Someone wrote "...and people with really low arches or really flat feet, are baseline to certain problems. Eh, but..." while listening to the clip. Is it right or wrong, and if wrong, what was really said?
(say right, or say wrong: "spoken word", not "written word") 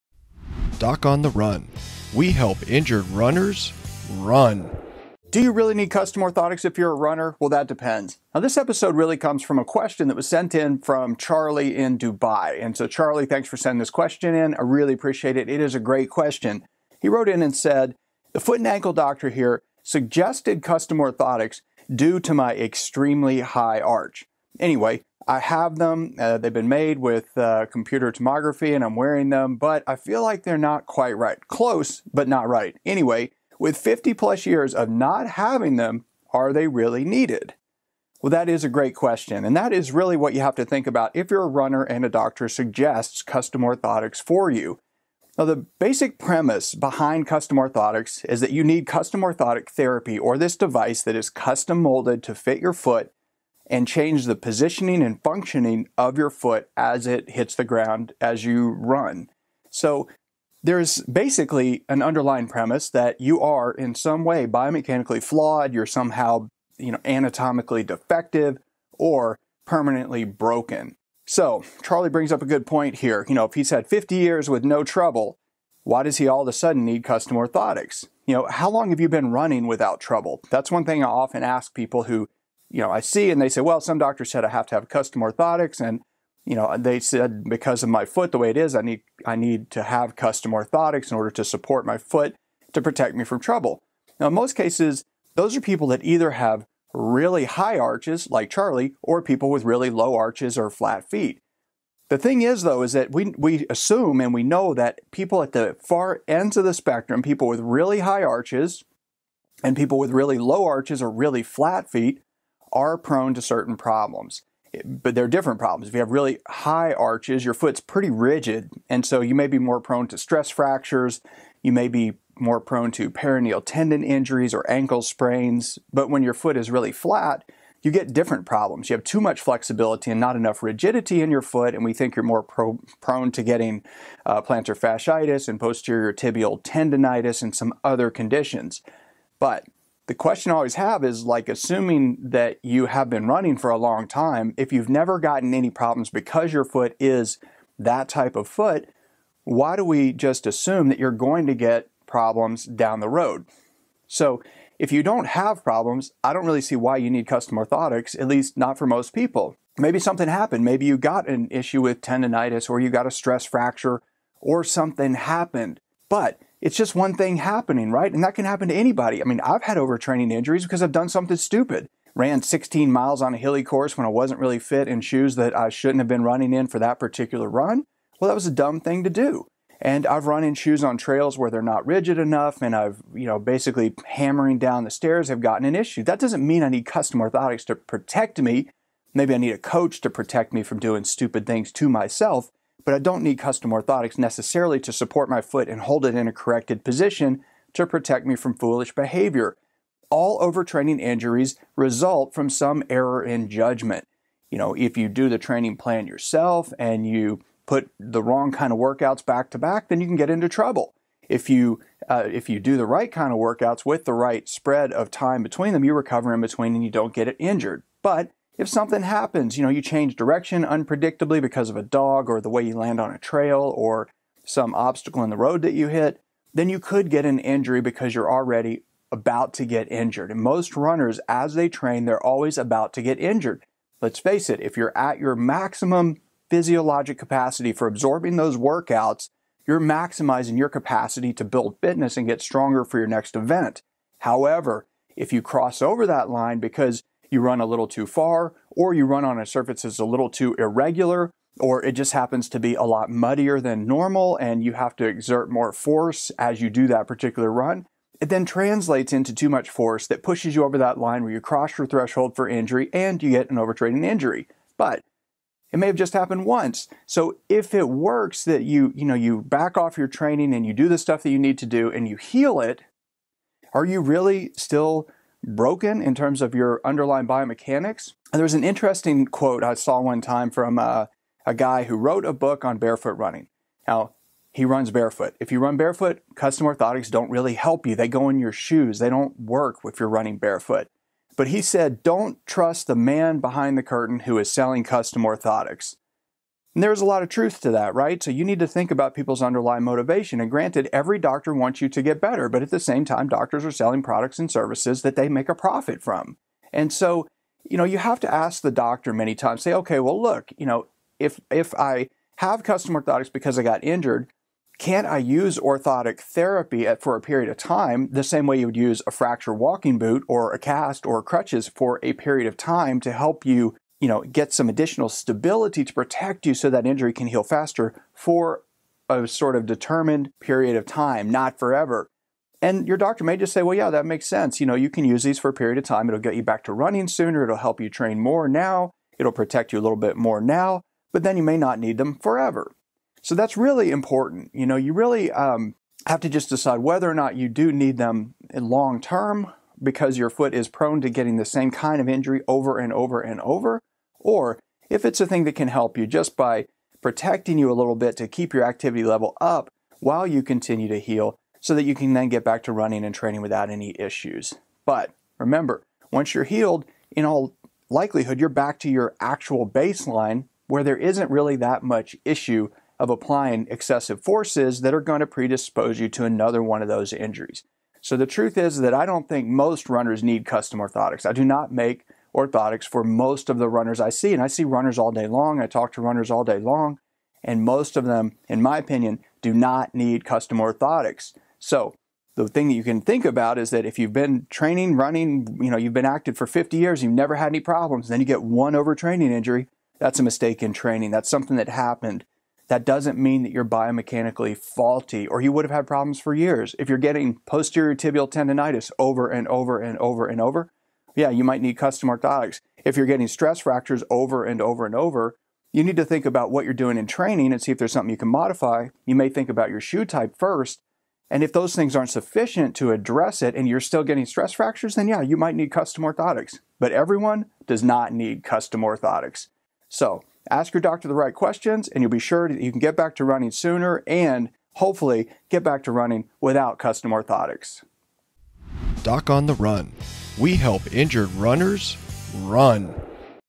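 wrong: "prone", not "baseline".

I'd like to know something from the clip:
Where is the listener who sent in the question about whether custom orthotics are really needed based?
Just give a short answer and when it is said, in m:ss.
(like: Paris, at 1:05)
Dubai, at 0:11.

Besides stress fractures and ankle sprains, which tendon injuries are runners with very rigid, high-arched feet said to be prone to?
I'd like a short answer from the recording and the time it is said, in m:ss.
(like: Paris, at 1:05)
Peroneal tendon injuries, at 2:03.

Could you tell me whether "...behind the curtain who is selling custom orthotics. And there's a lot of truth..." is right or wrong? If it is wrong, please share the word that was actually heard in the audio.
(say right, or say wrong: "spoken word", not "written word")
right.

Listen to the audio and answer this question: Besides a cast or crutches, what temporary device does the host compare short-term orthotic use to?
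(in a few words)
Fracture walking boot.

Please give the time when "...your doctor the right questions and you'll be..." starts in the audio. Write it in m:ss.
7:10.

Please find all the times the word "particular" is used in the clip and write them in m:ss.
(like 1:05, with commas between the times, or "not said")
2:56, 4:17.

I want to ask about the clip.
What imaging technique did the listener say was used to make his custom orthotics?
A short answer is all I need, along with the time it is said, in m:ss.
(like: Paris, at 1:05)
Computer tomography, at 0:27.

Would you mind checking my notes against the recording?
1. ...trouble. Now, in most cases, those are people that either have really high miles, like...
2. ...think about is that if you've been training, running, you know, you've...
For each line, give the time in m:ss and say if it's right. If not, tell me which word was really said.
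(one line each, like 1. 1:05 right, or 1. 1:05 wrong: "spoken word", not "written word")
1. 1:33 wrong: "arches", not "miles"
2. 6:33 right.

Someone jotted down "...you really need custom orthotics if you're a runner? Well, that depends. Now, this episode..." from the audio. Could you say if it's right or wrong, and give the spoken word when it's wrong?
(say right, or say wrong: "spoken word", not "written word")
right.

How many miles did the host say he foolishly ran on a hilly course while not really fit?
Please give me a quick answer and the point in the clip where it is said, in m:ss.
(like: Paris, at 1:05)
16, at 2:52.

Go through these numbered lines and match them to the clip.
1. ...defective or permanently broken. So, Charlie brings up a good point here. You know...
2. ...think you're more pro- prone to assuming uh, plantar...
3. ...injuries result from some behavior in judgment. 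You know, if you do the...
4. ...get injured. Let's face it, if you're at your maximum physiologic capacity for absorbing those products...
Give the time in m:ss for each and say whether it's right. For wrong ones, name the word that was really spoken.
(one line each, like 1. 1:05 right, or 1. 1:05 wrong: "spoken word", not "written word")
1. 1:07 right
2. 2:11 wrong: "getting", not "assuming"
3. 3:20 wrong: "error", not "behavior"
4. 3:53 wrong: "workouts", not "products".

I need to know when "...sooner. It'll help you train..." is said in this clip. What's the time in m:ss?
5:37.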